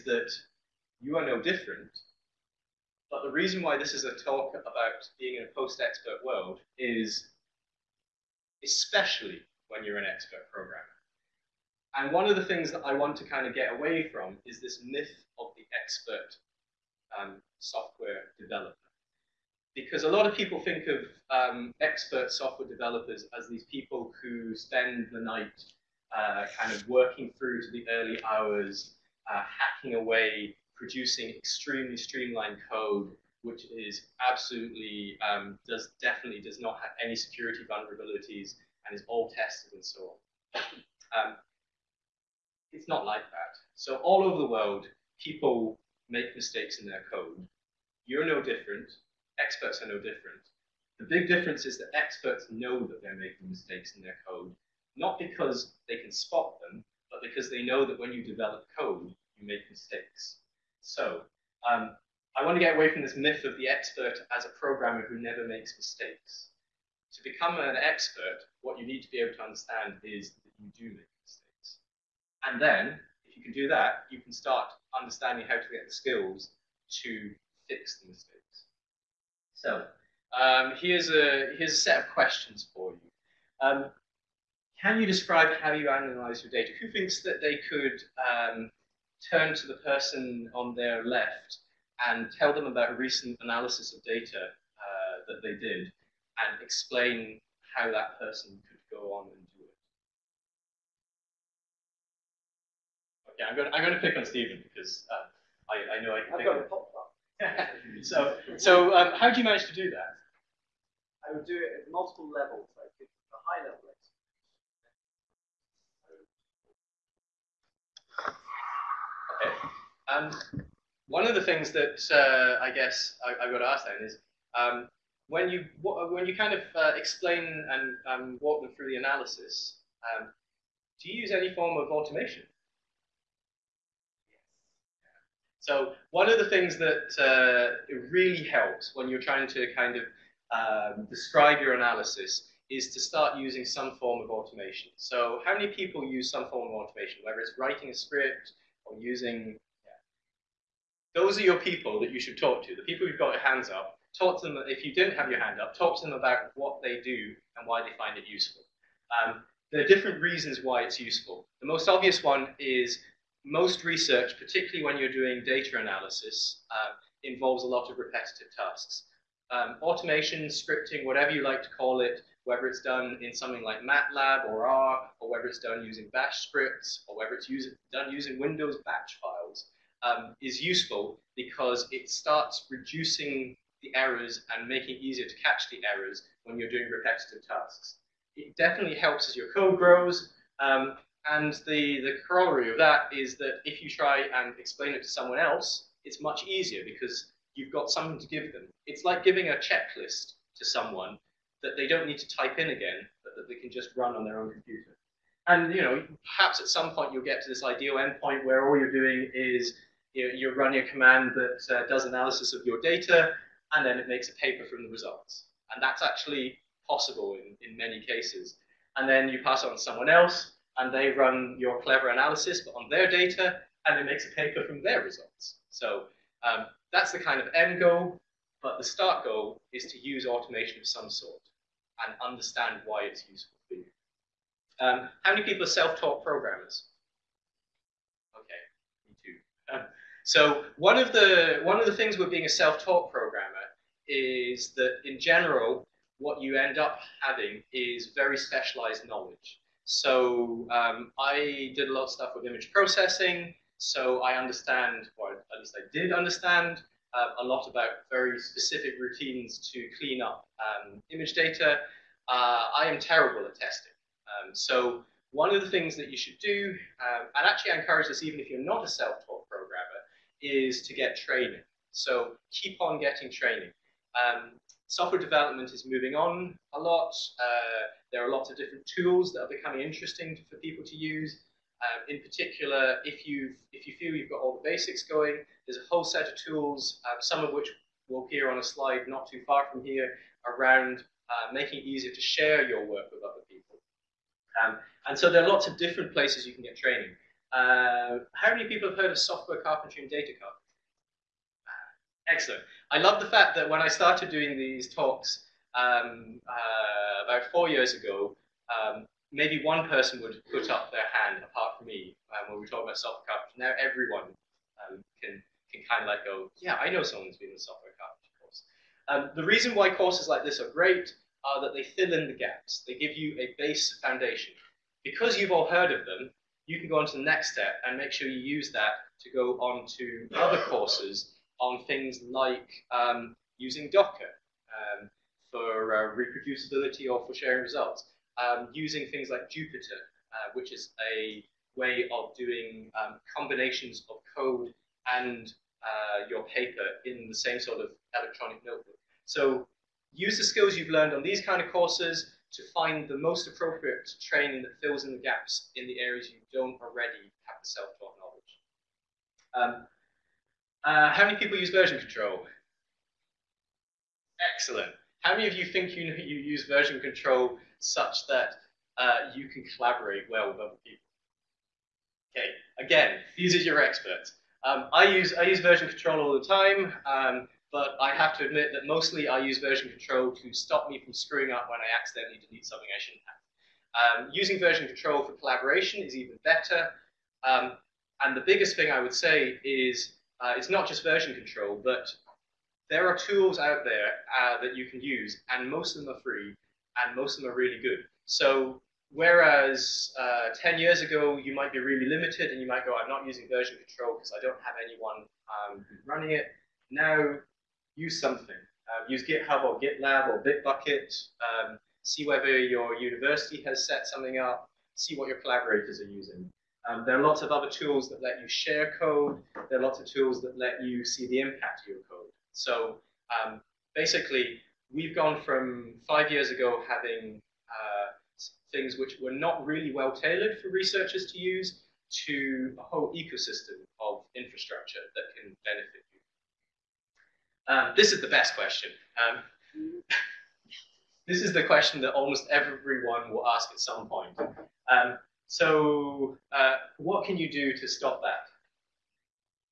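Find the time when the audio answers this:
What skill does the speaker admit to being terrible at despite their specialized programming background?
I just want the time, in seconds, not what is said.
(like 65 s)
263 s.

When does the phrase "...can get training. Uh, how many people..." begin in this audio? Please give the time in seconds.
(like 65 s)
296 s.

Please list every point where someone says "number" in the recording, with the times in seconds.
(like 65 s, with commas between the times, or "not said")
not said.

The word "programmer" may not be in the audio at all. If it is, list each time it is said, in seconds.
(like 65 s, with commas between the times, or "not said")
10 s, 64 s, 236 s, 243 s, 269 s.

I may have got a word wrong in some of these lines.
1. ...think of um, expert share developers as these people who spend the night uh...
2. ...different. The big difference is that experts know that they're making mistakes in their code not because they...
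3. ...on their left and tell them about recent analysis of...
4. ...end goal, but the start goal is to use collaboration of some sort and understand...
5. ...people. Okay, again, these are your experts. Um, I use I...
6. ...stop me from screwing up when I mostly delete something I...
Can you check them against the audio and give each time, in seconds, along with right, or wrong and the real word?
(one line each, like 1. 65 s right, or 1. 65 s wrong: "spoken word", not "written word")
1. 20 s wrong: "software", not "share"
2. 49 s right
3. 90 s right
4. 227 s wrong: "automation", not "collaboration"
5. 370 s right
6. 380 s wrong: "accidentally", not "mostly".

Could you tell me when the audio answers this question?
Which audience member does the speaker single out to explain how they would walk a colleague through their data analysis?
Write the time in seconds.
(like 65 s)
104 s.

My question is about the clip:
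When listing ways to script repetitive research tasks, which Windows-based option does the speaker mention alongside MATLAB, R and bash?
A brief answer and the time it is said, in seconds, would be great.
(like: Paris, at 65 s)
Windows batch files, at 178 s.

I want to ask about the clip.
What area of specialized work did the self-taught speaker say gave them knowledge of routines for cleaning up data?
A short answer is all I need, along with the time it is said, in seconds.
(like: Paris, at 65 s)
Image processing, at 252 s.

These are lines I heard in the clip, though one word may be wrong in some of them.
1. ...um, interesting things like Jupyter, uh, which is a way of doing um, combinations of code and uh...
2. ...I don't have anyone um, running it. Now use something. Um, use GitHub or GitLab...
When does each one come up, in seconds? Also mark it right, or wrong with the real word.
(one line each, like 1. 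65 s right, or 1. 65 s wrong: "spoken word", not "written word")
1. 338 s wrong: "using", not "interesting"
2. 404 s right.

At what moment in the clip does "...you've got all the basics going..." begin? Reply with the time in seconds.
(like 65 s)
284 s.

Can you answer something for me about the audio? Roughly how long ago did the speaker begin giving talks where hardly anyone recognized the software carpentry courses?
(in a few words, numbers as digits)
About 4 years ago.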